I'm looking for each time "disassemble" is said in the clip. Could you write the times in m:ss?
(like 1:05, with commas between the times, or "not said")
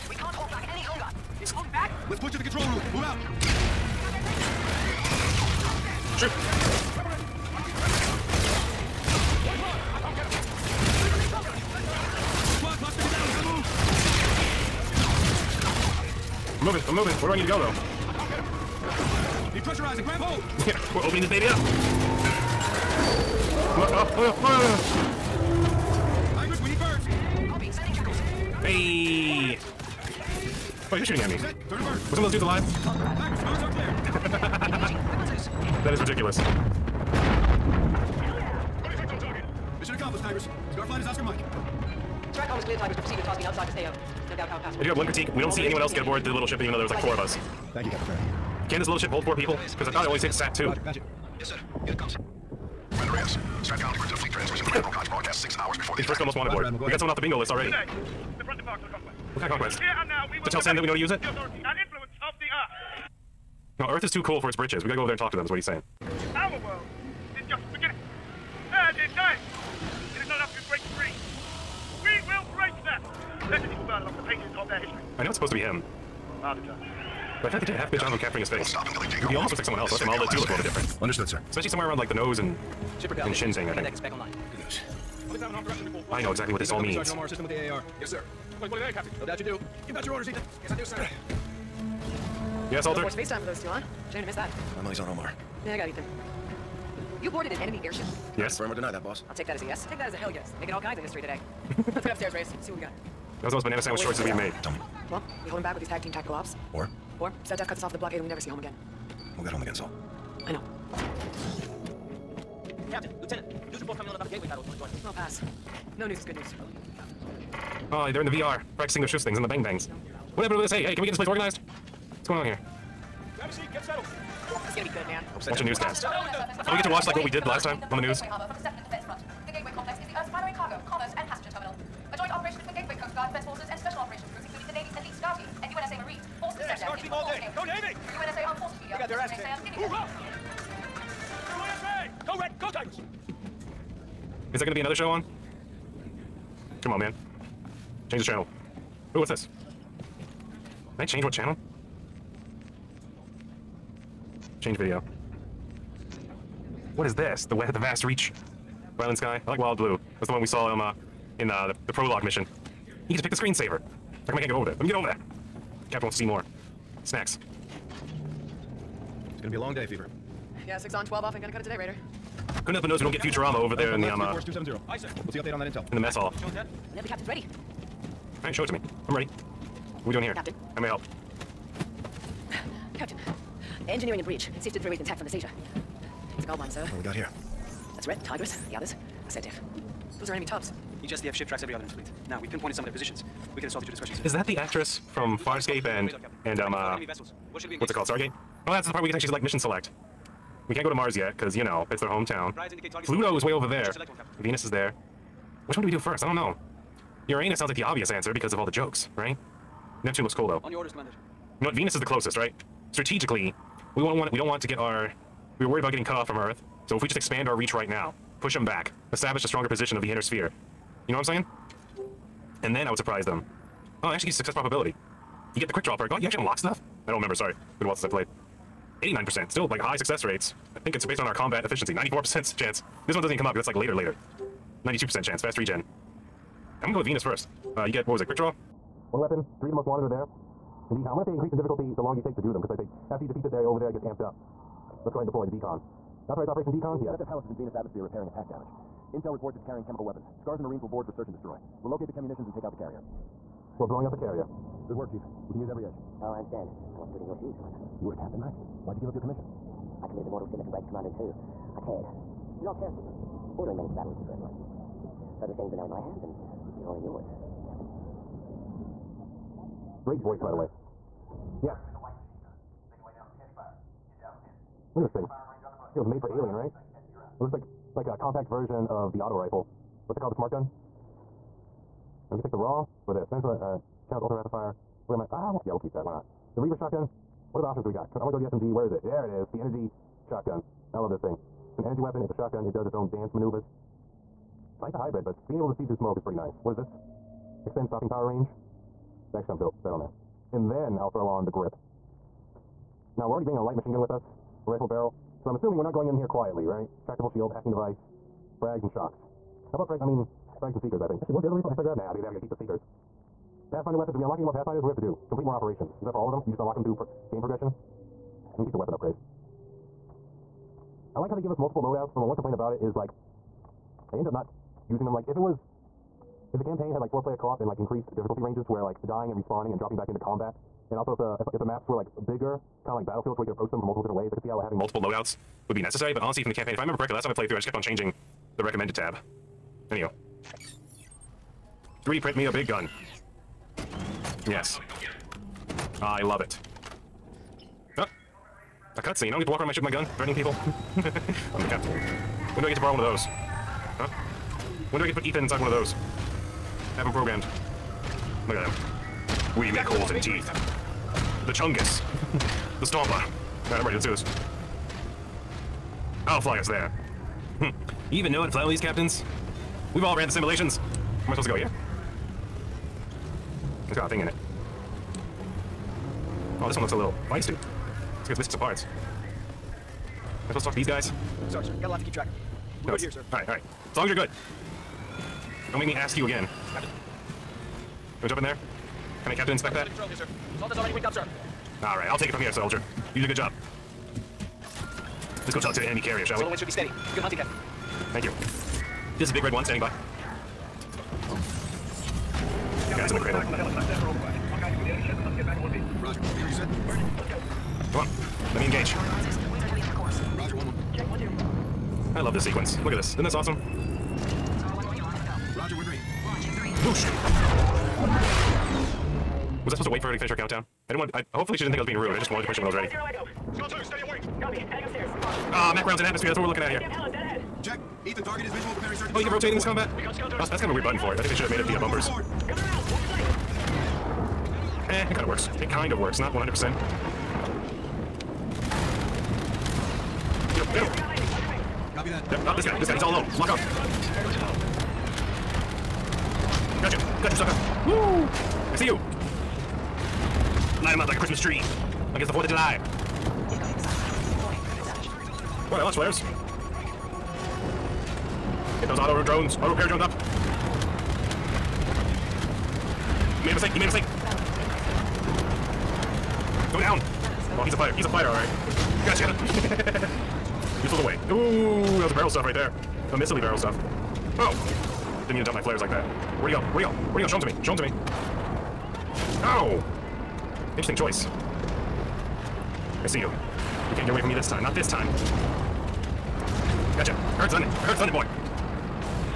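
not said.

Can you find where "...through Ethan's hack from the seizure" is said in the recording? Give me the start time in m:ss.
3:04.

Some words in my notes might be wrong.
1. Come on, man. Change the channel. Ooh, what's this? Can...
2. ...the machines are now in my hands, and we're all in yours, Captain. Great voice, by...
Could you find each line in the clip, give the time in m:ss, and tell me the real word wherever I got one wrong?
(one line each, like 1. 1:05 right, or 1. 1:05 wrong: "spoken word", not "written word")
1. 2:26 right
2. 4:25 right.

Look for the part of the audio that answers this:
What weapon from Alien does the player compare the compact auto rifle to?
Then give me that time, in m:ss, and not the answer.
4:40.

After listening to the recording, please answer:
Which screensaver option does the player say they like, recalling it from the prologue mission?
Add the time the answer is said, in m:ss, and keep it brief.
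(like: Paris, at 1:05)
Wild Blue, at 2:39.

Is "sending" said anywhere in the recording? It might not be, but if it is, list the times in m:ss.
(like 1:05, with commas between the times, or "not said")
0:27.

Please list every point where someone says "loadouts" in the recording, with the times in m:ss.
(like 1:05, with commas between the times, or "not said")
5:21, 5:35.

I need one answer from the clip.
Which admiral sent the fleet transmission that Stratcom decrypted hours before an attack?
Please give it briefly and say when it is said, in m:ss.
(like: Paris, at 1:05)
Admiral Kotch, at 0:54.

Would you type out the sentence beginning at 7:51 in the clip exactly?
Ooh, that was a barrel stuff right there.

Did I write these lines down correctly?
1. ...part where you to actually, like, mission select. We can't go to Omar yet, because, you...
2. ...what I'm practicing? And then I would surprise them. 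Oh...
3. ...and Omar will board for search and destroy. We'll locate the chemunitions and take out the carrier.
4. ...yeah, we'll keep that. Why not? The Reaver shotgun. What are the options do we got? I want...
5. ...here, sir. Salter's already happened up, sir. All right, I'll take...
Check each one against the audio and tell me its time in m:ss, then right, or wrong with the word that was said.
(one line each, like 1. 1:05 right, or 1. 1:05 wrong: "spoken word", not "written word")
1. 3:18 wrong: "Mars", not "Omar"
2. 3:41 wrong: "saying", not "practicing"
3. 4:10 wrong: "Marines", not "Omar"
4. 4:45 right
5. 6:30 wrong: "rigged", not "happened".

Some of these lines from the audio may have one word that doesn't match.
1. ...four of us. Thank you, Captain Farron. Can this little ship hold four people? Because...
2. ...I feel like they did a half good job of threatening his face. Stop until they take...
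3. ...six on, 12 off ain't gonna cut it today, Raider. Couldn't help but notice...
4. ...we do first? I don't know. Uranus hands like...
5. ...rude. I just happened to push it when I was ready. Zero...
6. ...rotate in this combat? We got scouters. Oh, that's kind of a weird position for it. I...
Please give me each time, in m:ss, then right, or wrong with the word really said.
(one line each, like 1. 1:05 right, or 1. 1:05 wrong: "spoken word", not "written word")
1. 0:47 right
2. 1:17 wrong: "capturing", not "threatening"
3. 2:50 right
4. 3:25 wrong: "sounds", not "hands"
5. 7:01 wrong: "wanted", not "happened"
6. 7:09 wrong: "button", not "position".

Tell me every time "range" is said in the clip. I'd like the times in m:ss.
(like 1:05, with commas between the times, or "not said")
4:58, 5:28.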